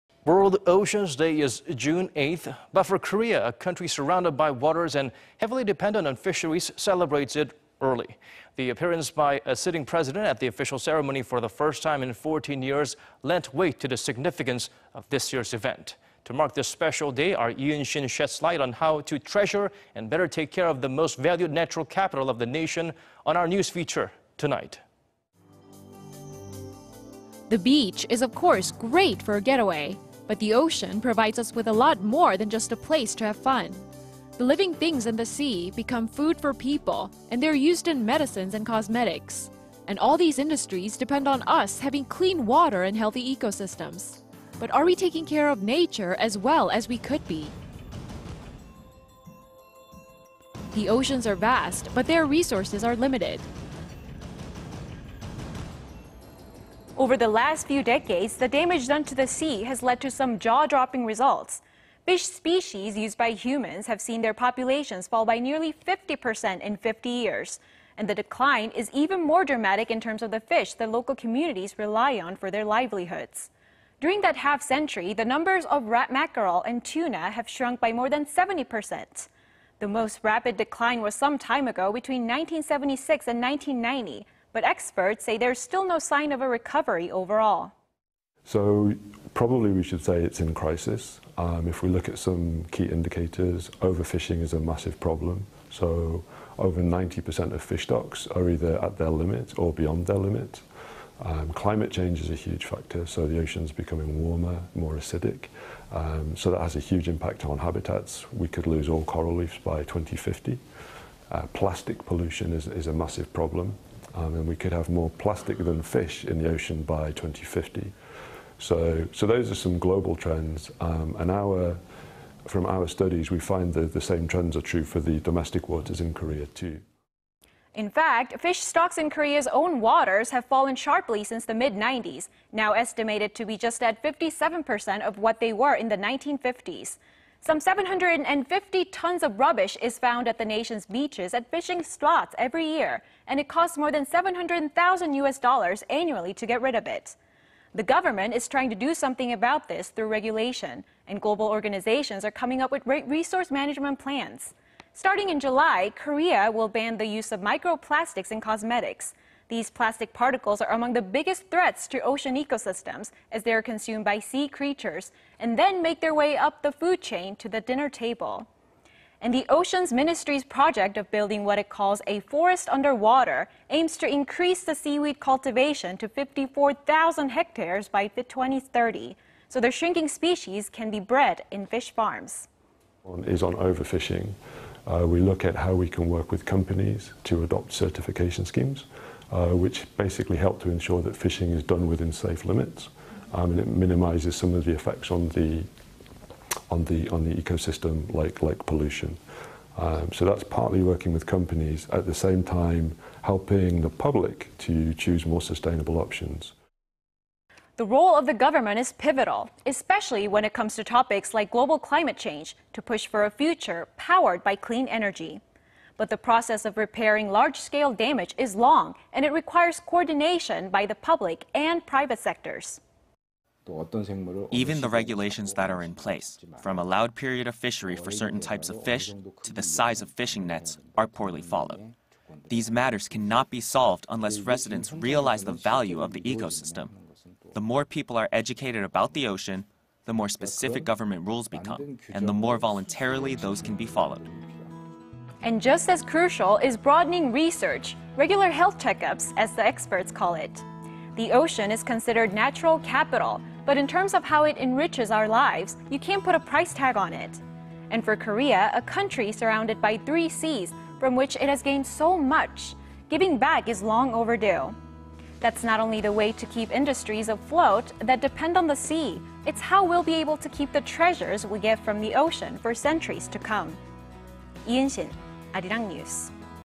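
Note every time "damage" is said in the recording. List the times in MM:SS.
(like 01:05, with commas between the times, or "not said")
00:58, 03:37.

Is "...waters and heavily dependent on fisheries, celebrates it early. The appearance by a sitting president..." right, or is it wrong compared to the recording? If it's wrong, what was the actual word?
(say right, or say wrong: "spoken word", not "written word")
right.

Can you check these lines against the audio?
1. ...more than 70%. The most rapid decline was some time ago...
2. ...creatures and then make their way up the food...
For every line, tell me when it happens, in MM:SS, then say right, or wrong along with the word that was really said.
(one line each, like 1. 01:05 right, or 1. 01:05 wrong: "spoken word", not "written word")
1. 01:17 right
2. 02:44 right.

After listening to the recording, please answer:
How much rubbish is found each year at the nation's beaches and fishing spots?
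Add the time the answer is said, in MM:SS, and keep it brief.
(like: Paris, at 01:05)
750 tons, at 02:17.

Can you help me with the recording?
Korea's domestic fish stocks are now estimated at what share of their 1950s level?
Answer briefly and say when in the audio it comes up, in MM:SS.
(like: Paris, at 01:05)
57%, at 02:14.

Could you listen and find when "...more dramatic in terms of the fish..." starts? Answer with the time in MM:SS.
01:09.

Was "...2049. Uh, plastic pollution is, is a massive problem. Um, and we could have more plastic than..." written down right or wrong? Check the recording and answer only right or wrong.
wrong.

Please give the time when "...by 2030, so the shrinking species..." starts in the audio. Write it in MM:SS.
02:57.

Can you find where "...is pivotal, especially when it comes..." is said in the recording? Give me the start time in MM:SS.
03:28.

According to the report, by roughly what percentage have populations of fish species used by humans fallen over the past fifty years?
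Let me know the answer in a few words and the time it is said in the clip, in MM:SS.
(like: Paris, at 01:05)
nearly 50%, at 01:05.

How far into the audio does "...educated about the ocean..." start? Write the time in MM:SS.
03:58.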